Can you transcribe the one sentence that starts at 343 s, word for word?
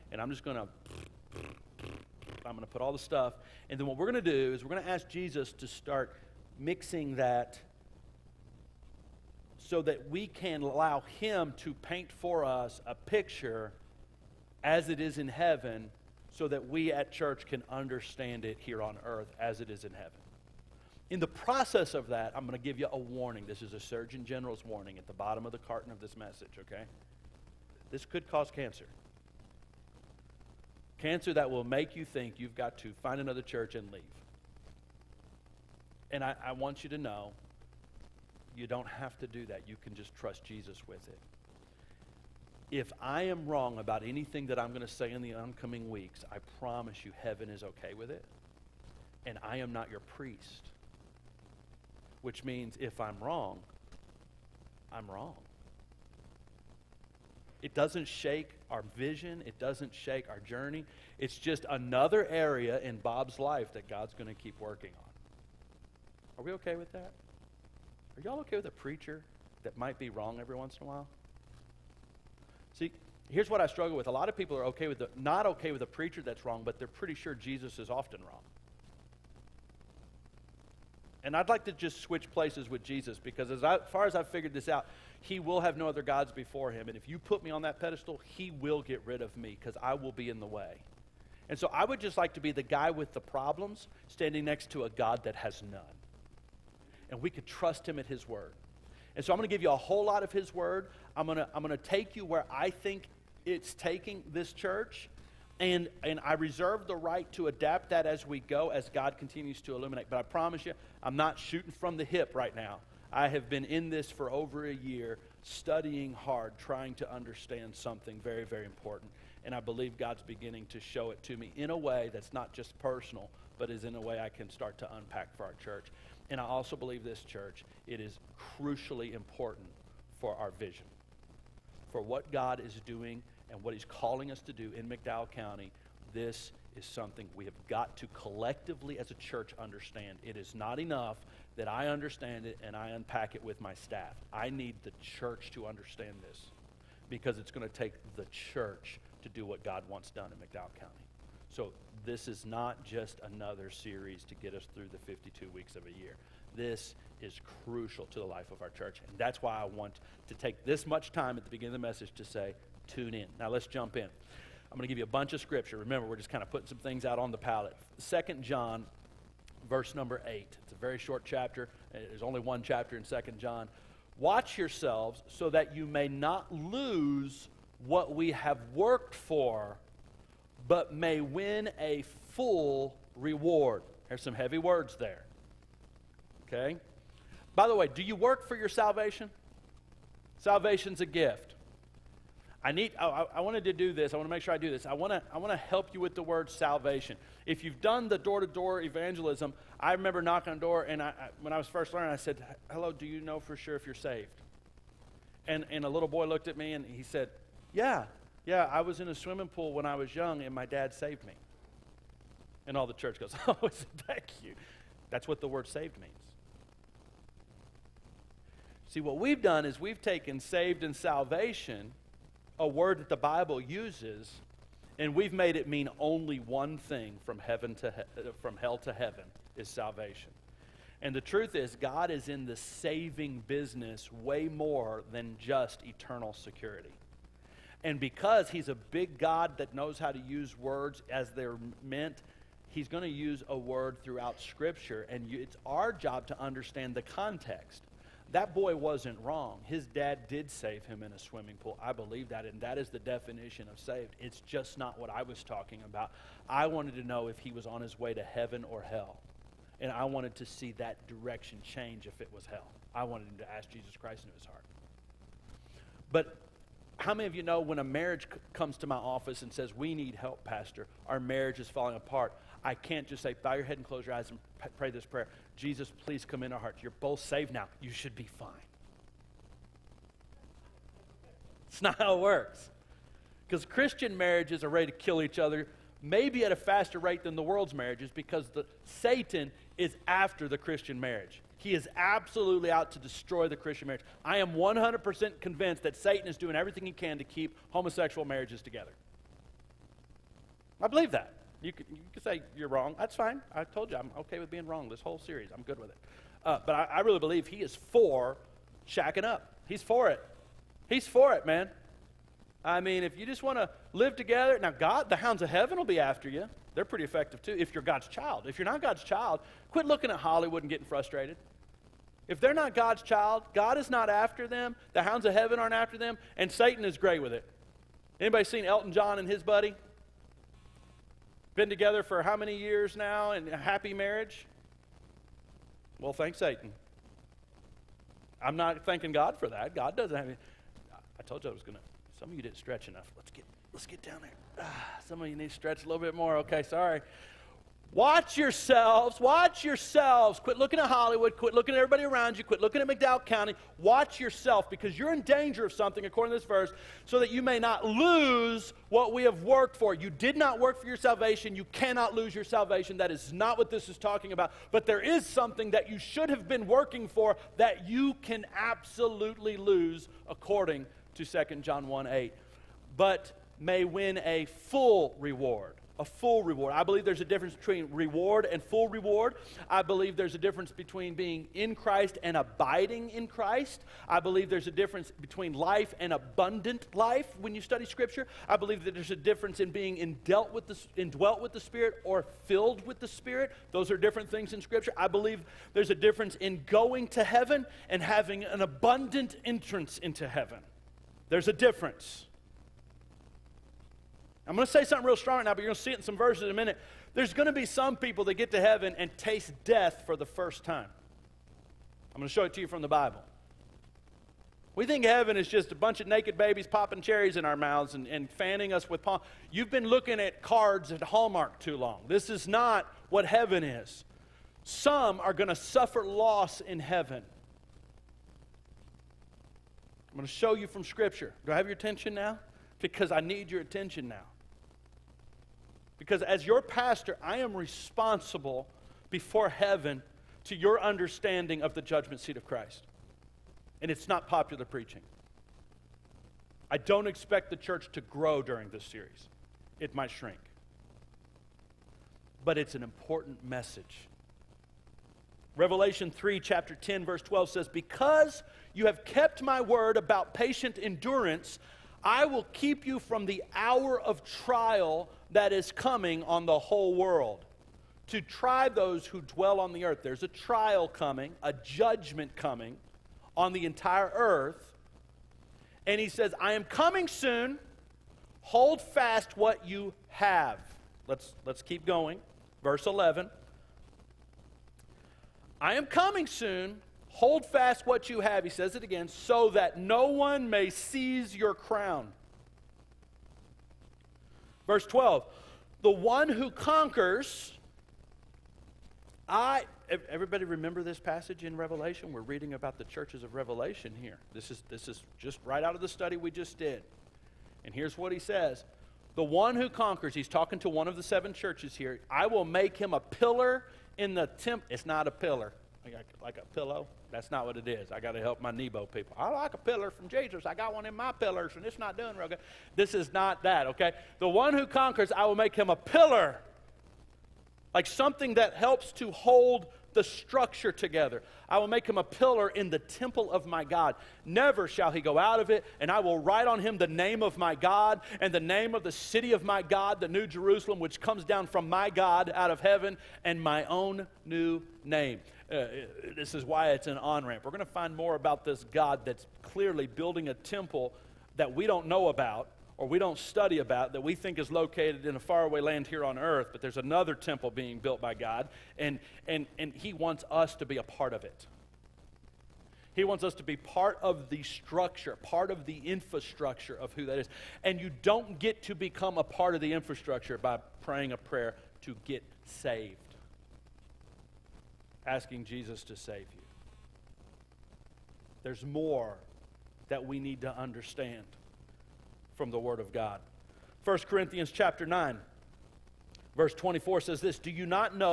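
Let's get, let's get down there.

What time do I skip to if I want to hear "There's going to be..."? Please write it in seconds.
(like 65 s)
407 s.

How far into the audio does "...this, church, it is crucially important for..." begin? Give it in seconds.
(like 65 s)
127 s.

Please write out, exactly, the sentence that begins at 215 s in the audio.
That's what the word saved means.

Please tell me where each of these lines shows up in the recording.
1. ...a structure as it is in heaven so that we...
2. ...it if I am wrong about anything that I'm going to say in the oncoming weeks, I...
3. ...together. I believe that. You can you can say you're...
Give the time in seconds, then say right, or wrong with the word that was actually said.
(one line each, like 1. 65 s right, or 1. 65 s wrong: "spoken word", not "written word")
1. 12 s wrong: "picture", not "structure"
2. 41 s right
3. 298 s right.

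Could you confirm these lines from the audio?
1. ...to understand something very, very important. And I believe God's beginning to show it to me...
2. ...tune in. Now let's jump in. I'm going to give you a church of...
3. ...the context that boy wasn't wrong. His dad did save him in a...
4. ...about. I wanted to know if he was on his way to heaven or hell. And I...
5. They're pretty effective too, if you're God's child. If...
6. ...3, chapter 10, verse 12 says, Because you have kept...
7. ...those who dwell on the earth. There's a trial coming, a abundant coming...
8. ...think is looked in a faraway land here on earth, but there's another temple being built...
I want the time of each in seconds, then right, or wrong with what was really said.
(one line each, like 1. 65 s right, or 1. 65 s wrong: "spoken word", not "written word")
1. 116 s right
2. 162 s wrong: "bunch", not "church"
3. 246 s right
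4. 255 s right
5. 316 s right
6. 456 s right
7. 468 s wrong: "judgment", not "abundant"
8. 554 s wrong: "located", not "looked".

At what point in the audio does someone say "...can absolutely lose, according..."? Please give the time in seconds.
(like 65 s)
368 s.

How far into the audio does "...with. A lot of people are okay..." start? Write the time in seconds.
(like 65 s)
73 s.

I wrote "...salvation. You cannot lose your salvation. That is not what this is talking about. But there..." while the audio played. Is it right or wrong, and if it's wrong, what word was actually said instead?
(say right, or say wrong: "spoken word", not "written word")
right.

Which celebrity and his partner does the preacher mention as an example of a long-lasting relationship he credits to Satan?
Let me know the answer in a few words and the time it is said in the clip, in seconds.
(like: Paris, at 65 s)
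Elton John, at 328 s.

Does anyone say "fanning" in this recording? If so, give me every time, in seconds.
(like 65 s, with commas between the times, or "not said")
418 s.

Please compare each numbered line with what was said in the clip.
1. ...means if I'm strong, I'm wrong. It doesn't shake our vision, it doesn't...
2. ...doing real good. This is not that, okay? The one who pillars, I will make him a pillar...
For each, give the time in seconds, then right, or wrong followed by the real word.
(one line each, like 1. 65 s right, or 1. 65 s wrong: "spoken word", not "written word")
1. 52 s wrong: "wrong", not "strong"
2. 521 s wrong: "conquers", not "pillars".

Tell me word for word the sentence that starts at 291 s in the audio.
He is absolutely out to destroy the Christian marriage.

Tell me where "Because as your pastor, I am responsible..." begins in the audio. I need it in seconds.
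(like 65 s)
435 s.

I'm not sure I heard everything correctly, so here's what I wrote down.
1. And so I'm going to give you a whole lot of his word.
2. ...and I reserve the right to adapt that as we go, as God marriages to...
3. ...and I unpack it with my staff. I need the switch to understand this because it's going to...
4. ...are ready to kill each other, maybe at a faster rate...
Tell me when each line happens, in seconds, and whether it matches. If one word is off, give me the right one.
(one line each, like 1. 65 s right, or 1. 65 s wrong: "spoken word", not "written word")
1. 99 s right
2. 106 s wrong: "continues", not "marriages"
3. 142 s wrong: "church", not "switch"
4. 284 s right.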